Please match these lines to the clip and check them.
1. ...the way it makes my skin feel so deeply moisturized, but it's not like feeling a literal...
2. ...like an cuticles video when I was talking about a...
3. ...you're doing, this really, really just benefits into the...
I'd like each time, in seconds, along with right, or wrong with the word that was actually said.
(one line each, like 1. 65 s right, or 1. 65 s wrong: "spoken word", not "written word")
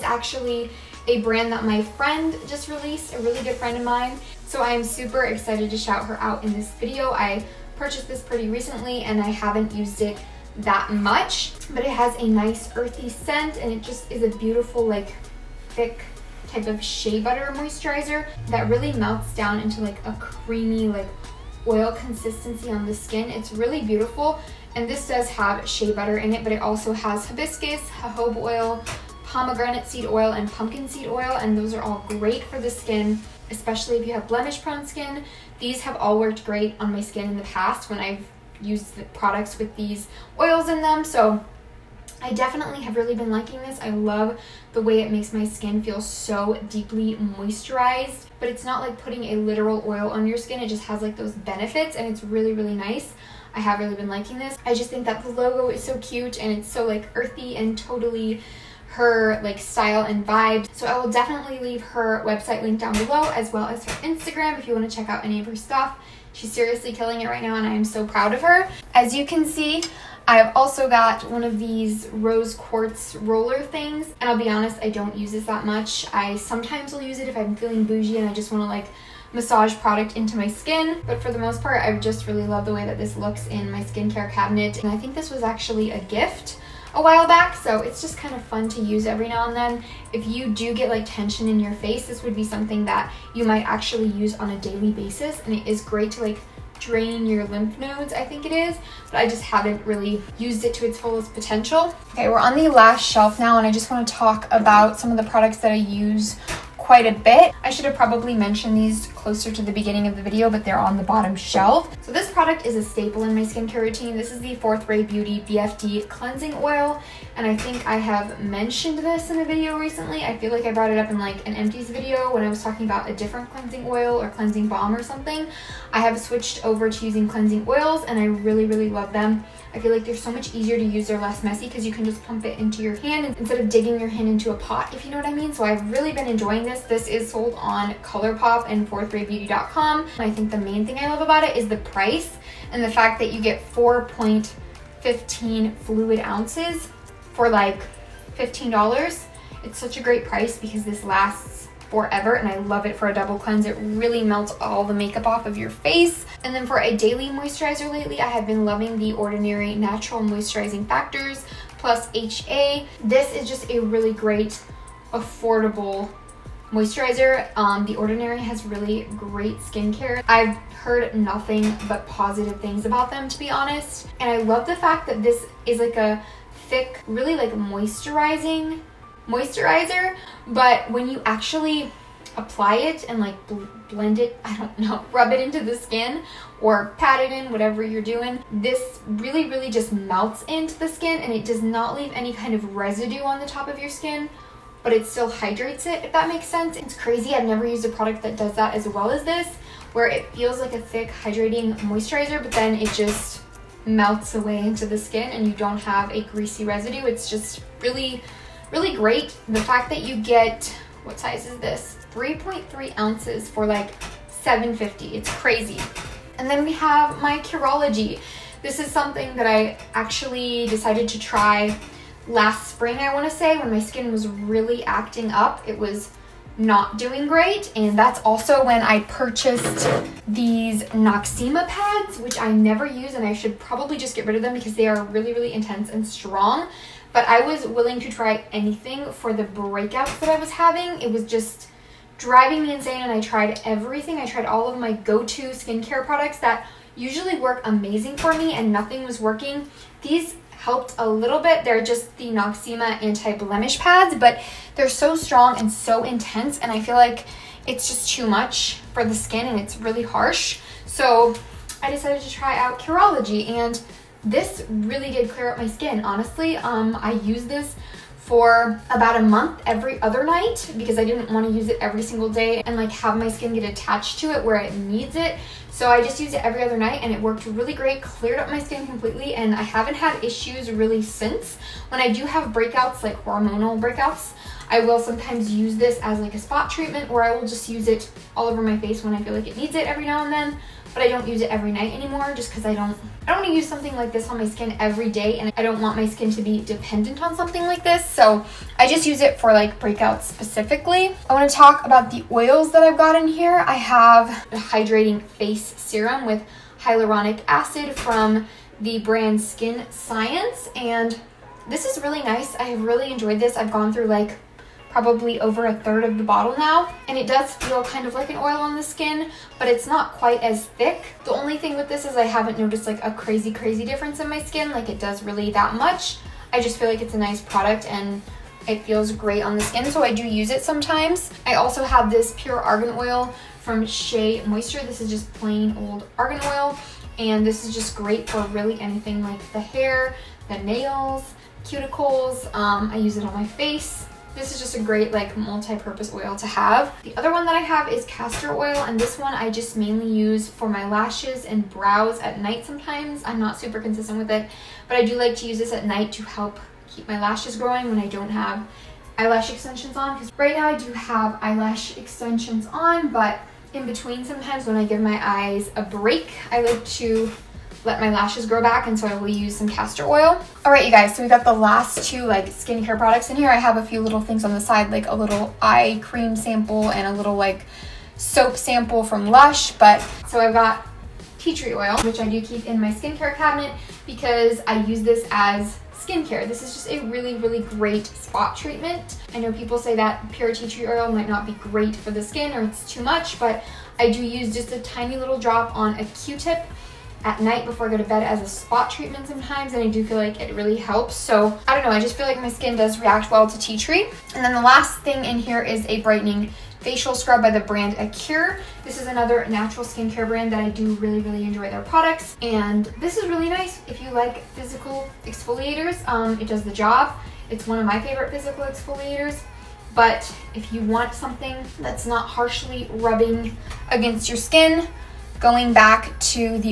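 1. 44 s wrong: "putting", not "feeling"
2. 121 s wrong: "empties", not "cuticles"
3. 187 s wrong: "melts", not "benefits".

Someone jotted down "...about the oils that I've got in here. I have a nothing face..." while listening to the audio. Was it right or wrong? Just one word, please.
wrong.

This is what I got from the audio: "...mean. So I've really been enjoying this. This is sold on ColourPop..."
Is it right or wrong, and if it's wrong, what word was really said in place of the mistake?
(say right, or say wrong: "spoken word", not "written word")
right.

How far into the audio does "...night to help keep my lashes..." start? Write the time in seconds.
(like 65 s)
355 s.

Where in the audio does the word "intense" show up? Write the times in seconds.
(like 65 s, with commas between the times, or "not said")
235 s, 256 s.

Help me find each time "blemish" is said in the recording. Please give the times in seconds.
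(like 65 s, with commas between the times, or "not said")
34 s, 253 s.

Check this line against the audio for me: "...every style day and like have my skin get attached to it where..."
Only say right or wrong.
wrong.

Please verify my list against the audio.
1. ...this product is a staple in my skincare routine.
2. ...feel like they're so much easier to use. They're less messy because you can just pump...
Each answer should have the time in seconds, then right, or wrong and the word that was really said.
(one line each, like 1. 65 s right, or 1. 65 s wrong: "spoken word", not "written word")
1. 112 s right
2. 129 s right.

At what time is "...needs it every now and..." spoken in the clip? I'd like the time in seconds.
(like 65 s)
289 s.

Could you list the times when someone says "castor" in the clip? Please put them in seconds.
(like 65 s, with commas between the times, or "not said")
348 s, 369 s.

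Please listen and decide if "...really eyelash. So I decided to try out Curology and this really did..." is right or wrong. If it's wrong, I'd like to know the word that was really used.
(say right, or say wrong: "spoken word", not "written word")
wrong: "harsh", not "eyelash".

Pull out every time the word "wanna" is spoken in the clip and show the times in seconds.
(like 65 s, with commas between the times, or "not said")
103 s, 223 s.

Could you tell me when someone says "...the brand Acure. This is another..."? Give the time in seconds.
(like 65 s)
407 s.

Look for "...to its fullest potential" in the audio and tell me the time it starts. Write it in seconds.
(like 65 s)
100 s.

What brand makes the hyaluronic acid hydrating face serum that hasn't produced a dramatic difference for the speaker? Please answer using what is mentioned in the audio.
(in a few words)
Skin Science.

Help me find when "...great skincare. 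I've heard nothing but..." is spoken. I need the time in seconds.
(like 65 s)
169 s.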